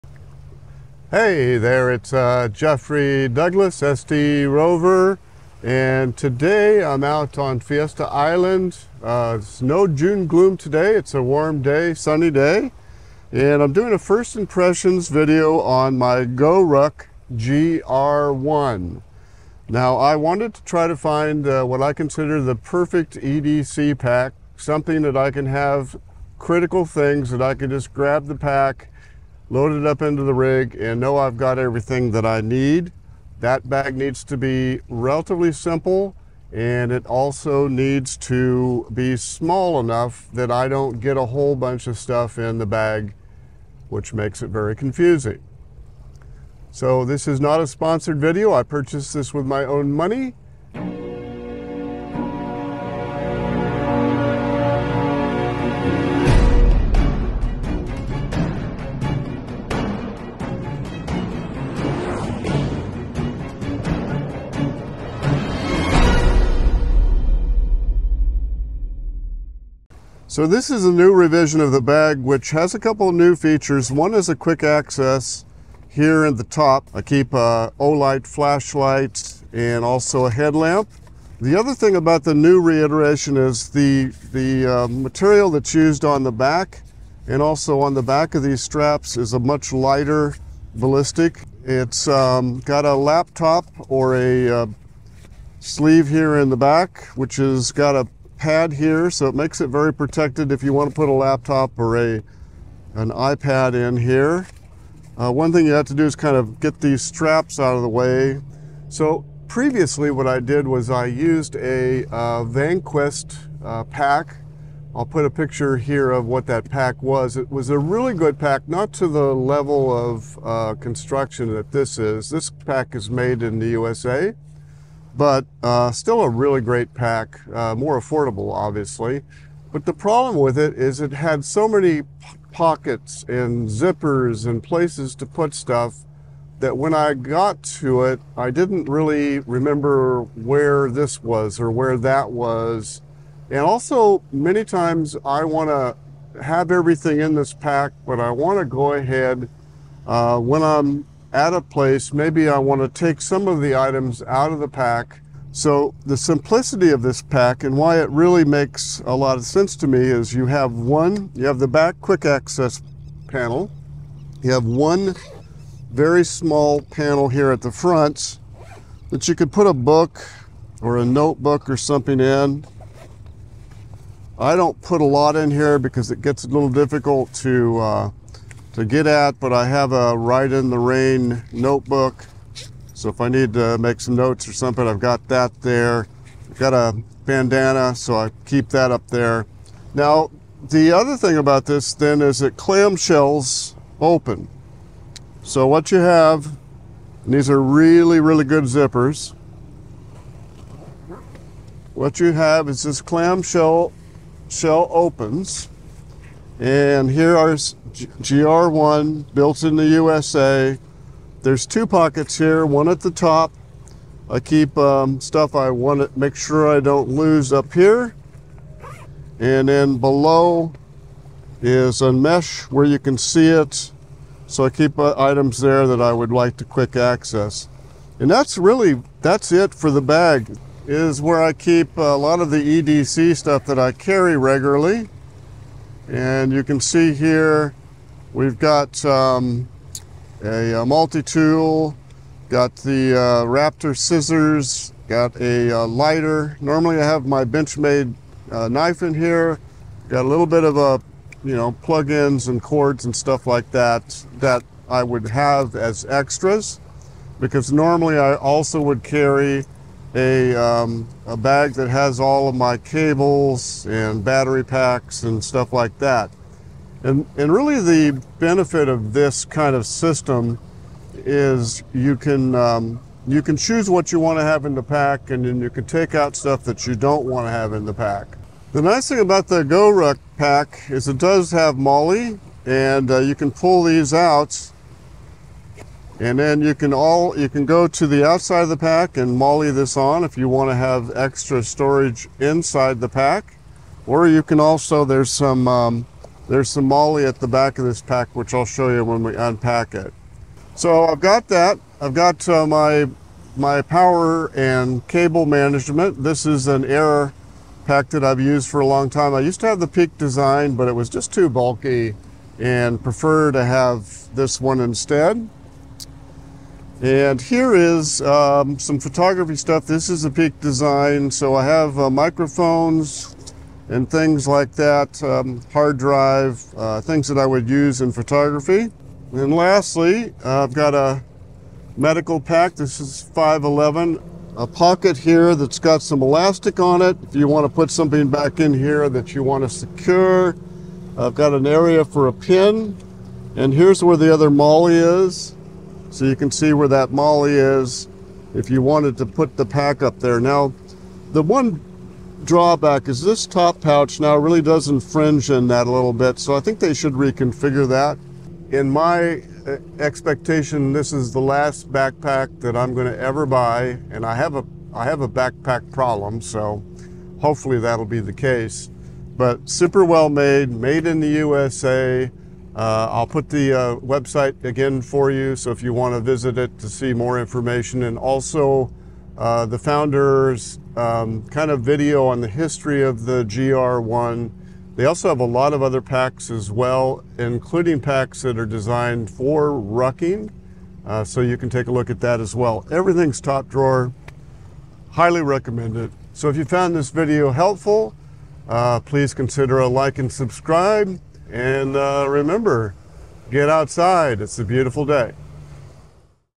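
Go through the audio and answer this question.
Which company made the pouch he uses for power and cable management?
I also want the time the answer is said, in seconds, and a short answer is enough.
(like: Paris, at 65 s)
Aer, at 306 s.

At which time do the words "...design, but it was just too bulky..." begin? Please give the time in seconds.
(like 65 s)
310 s.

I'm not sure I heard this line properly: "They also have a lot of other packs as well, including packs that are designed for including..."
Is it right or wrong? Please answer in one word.
wrong.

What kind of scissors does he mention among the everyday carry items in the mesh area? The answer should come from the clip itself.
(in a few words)
Raptor scissors.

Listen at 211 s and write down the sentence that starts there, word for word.
There's two pockets here, one at the top.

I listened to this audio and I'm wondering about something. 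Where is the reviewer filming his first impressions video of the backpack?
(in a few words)
Fiesta Island.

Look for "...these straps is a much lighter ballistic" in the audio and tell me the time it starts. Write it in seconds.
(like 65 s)
88 s.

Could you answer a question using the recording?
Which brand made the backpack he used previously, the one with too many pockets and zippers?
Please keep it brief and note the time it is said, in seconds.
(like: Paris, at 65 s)
Vanquest, at 112 s.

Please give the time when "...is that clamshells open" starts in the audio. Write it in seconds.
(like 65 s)
192 s.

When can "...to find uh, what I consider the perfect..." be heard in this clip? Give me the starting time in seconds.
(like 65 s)
20 s.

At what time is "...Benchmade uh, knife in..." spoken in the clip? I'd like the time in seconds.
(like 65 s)
247 s.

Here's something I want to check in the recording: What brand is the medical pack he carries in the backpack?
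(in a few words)
511.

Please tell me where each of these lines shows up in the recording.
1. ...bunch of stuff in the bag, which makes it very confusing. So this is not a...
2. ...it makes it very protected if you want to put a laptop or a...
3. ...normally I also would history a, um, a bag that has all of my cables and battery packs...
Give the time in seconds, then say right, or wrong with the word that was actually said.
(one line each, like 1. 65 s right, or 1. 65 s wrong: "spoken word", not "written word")
1. 41 s right
2. 99 s right
3. 257 s wrong: "carry", not "history".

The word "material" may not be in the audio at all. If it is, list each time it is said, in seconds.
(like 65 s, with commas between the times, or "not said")
84 s.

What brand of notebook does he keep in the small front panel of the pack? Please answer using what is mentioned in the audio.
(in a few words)
Rite in the Rain.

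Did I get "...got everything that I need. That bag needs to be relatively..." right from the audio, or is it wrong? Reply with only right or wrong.
right.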